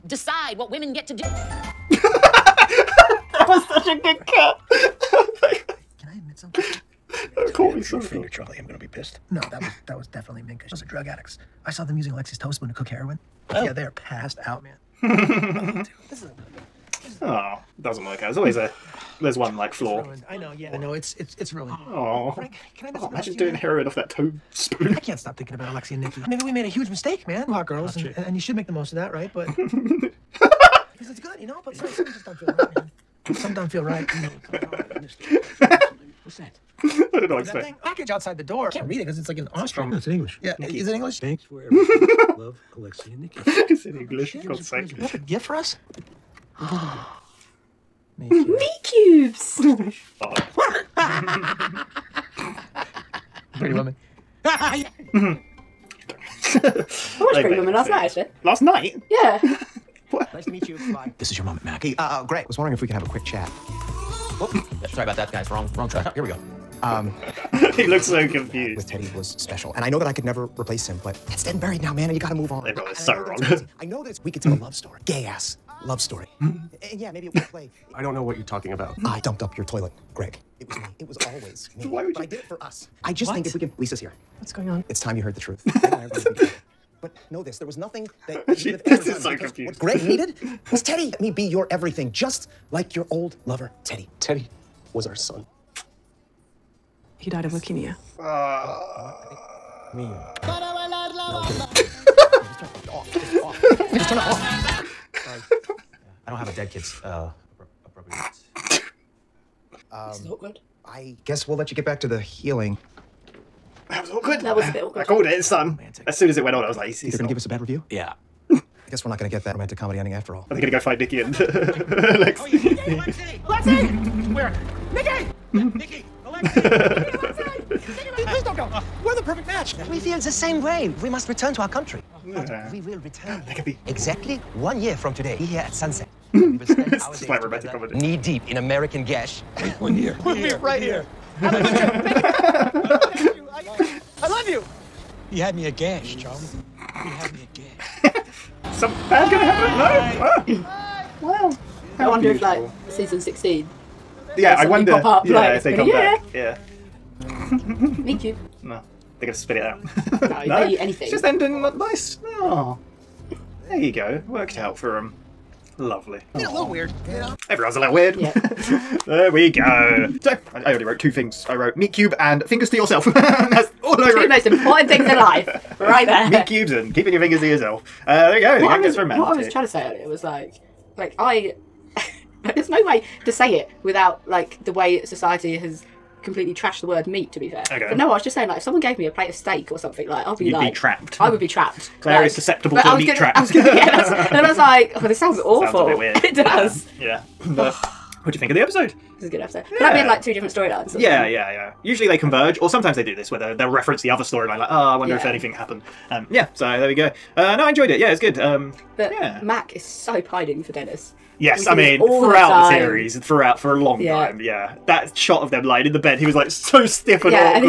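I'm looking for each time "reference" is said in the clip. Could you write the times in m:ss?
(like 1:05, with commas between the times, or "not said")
3:23.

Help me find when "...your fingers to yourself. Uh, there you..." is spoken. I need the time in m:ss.
2:57.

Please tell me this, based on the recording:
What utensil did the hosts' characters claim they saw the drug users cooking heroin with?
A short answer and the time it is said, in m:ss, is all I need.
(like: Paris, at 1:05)
toast spoon, at 0:12.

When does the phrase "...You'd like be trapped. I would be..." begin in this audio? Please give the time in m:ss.
3:10.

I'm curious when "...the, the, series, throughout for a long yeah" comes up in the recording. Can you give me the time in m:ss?
3:32.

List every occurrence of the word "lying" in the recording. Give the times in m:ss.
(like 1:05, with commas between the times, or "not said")
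3:35.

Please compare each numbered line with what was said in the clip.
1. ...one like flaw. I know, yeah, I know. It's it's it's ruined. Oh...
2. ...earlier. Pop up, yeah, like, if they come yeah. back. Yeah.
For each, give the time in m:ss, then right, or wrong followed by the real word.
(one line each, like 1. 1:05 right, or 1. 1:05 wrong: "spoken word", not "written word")
1. 0:19 right
2. 2:34 wrong: "wonder", not "earlier".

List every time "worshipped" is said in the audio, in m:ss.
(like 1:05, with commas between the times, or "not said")
not said.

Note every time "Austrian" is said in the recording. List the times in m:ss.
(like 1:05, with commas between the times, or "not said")
0:39.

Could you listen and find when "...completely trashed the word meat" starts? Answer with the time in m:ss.
3:06.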